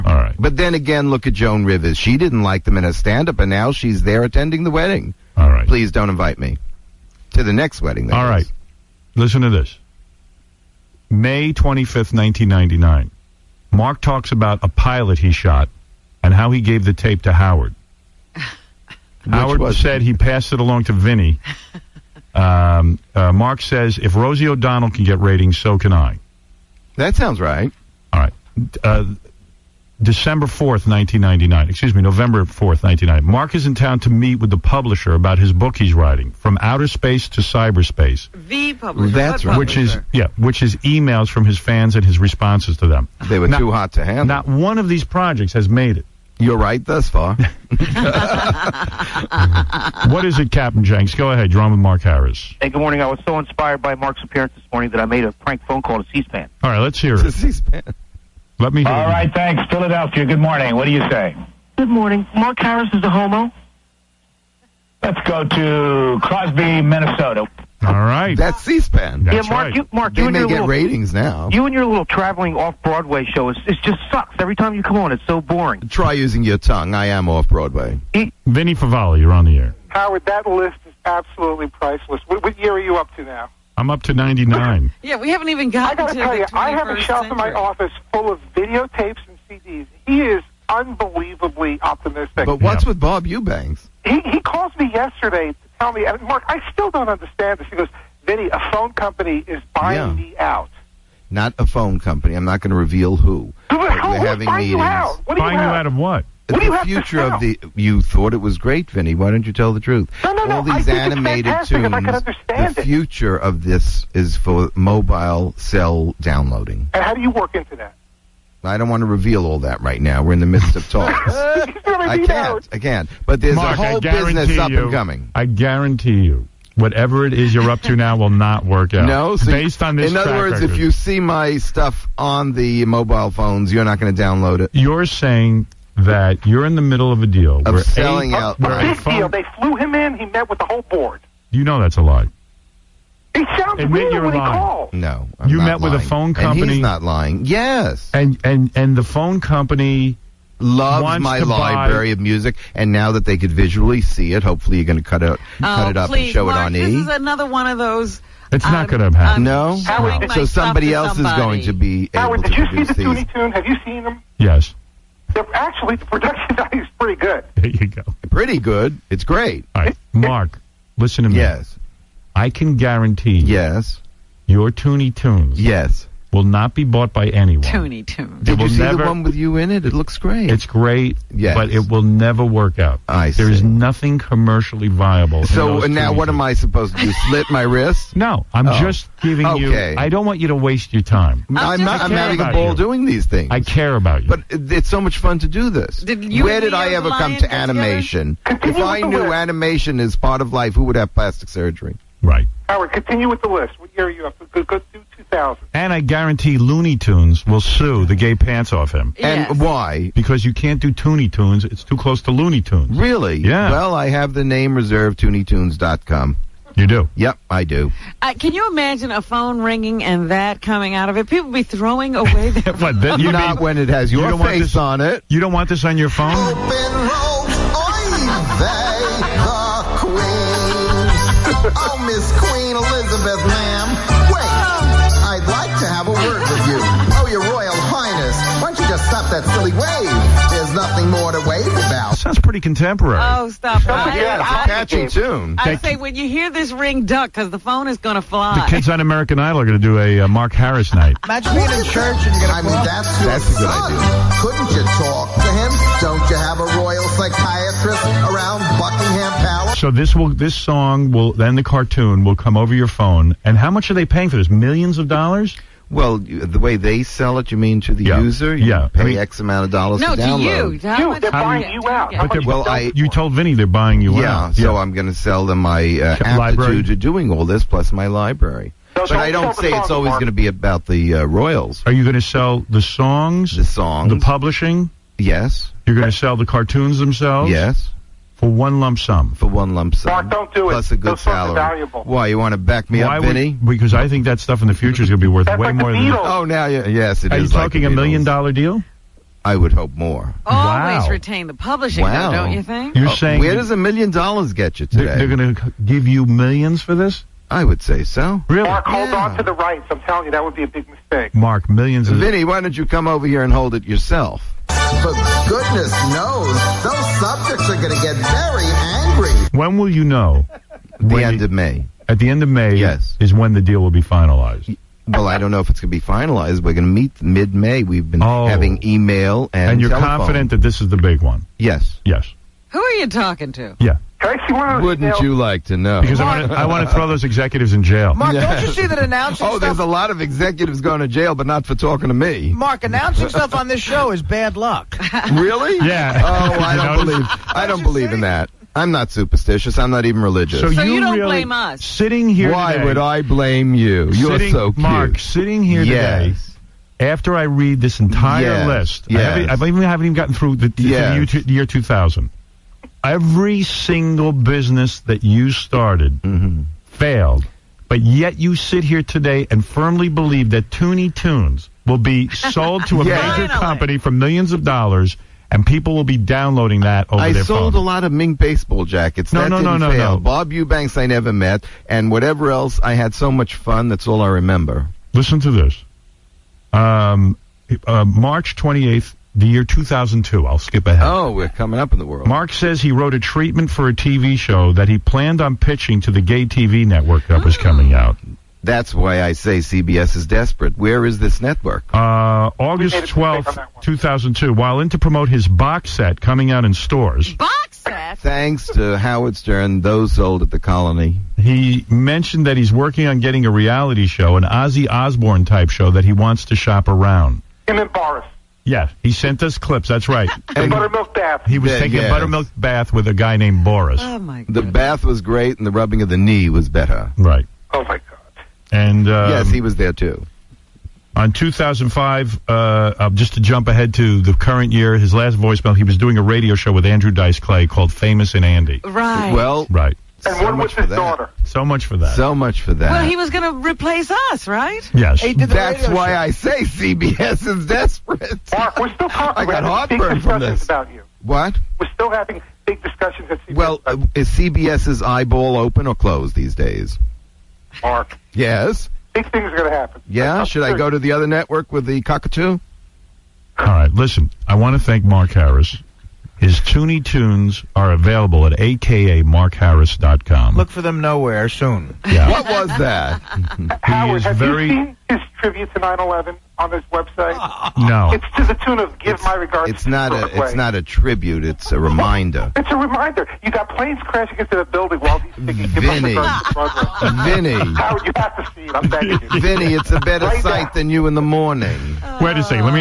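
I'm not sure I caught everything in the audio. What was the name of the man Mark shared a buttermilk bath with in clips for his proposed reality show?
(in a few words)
Boris.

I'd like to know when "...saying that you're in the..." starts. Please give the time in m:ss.
2:15.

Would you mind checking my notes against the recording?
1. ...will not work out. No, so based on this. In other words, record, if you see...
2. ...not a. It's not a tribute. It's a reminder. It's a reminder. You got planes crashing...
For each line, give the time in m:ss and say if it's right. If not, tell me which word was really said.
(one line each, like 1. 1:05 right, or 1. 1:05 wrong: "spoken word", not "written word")
1. 2:08 right
2. 7:59 right.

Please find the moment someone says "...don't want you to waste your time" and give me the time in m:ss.
3:10.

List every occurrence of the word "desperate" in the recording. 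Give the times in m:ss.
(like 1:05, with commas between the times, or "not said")
6:40, 7:27.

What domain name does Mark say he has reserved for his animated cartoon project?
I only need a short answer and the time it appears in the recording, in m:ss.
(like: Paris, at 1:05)
ToonieTunes.com, at 3:35.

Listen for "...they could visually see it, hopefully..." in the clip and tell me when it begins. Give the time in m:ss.
2:33.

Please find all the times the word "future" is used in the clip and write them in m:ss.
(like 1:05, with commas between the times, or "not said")
1:46, 1:52, 4:54.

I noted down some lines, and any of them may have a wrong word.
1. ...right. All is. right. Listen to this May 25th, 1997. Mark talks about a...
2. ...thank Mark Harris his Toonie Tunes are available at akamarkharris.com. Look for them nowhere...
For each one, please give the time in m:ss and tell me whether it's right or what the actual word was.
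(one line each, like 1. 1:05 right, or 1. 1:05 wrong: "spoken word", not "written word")
1. 0:08 wrong: "1999", not "1997"
2. 7:44 right.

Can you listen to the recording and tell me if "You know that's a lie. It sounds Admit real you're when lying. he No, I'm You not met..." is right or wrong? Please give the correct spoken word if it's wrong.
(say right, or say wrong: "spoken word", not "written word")
right.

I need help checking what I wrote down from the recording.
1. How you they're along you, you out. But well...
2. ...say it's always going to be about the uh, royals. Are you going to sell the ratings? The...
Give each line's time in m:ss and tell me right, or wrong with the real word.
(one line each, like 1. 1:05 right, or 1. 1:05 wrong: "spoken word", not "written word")
1. 4:30 wrong: "buying", not "along"
2. 4:39 wrong: "songs", not "ratings".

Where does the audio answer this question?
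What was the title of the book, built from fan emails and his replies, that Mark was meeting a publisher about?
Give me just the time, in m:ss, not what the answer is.
0:36.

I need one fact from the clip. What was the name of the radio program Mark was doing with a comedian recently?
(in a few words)
Famous and Andy.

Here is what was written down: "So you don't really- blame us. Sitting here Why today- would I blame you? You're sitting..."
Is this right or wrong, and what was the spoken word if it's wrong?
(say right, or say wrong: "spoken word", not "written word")
right.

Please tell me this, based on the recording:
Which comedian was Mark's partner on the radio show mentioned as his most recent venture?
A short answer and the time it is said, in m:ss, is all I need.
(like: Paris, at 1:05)
Andrew Dice Clay, at 7:16.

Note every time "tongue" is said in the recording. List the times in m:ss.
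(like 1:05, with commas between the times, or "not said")
1:16.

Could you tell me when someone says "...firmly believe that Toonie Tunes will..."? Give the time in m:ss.
6:09.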